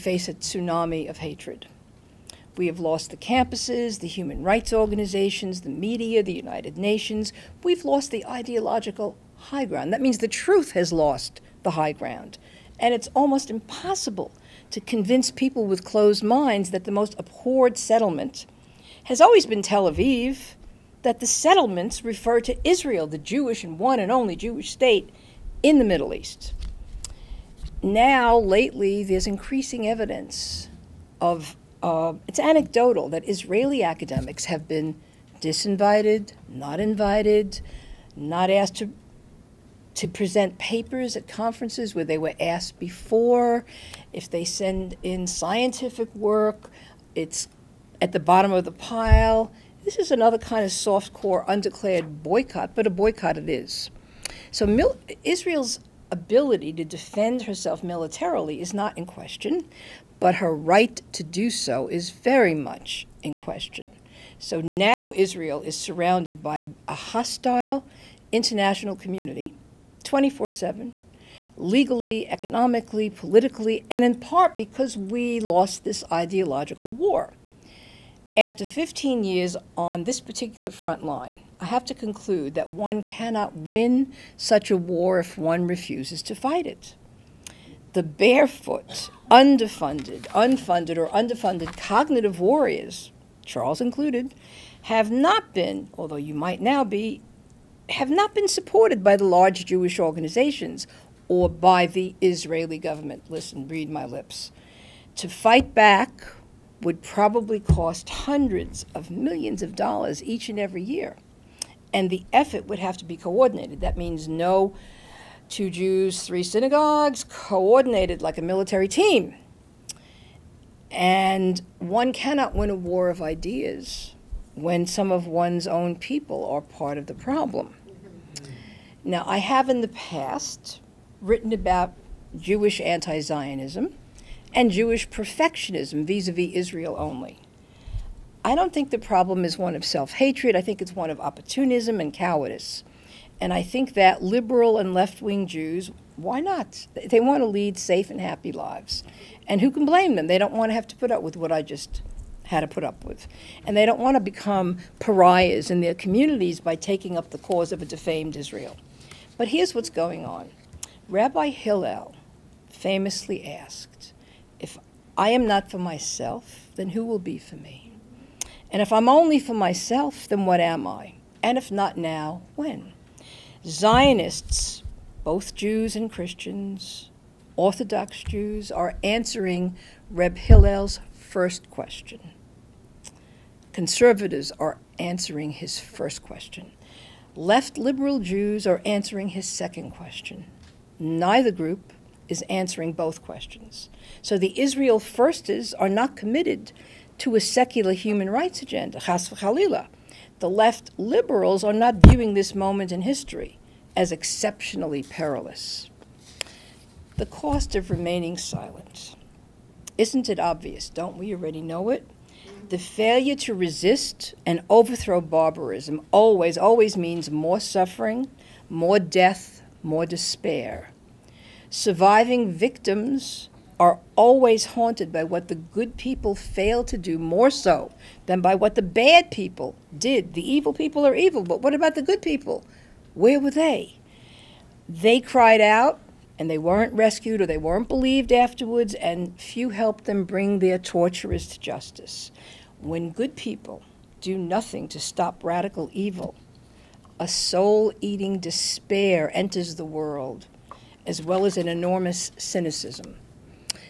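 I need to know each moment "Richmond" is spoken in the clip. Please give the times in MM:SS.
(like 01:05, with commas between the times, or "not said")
not said.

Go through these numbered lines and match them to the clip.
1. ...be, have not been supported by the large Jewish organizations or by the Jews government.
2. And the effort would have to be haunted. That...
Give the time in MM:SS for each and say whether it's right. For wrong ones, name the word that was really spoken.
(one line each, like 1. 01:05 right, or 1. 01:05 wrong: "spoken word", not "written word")
1. 01:36 wrong: "Israeli", not "Jews"
2. 01:51 wrong: "coordinated", not "haunted".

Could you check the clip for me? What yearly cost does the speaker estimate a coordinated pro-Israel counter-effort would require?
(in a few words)
Hundreds of millions of dollars.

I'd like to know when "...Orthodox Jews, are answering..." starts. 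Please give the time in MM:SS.
02:57.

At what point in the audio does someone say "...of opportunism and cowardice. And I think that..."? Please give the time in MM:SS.
02:21.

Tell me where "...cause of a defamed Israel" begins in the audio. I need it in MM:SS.
02:37.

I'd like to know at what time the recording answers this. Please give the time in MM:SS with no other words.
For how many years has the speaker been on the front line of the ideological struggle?
01:18.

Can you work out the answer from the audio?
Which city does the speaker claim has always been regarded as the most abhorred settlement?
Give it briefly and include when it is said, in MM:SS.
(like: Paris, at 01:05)
Tel Aviv, at 00:19.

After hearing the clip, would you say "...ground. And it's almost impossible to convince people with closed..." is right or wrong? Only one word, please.
right.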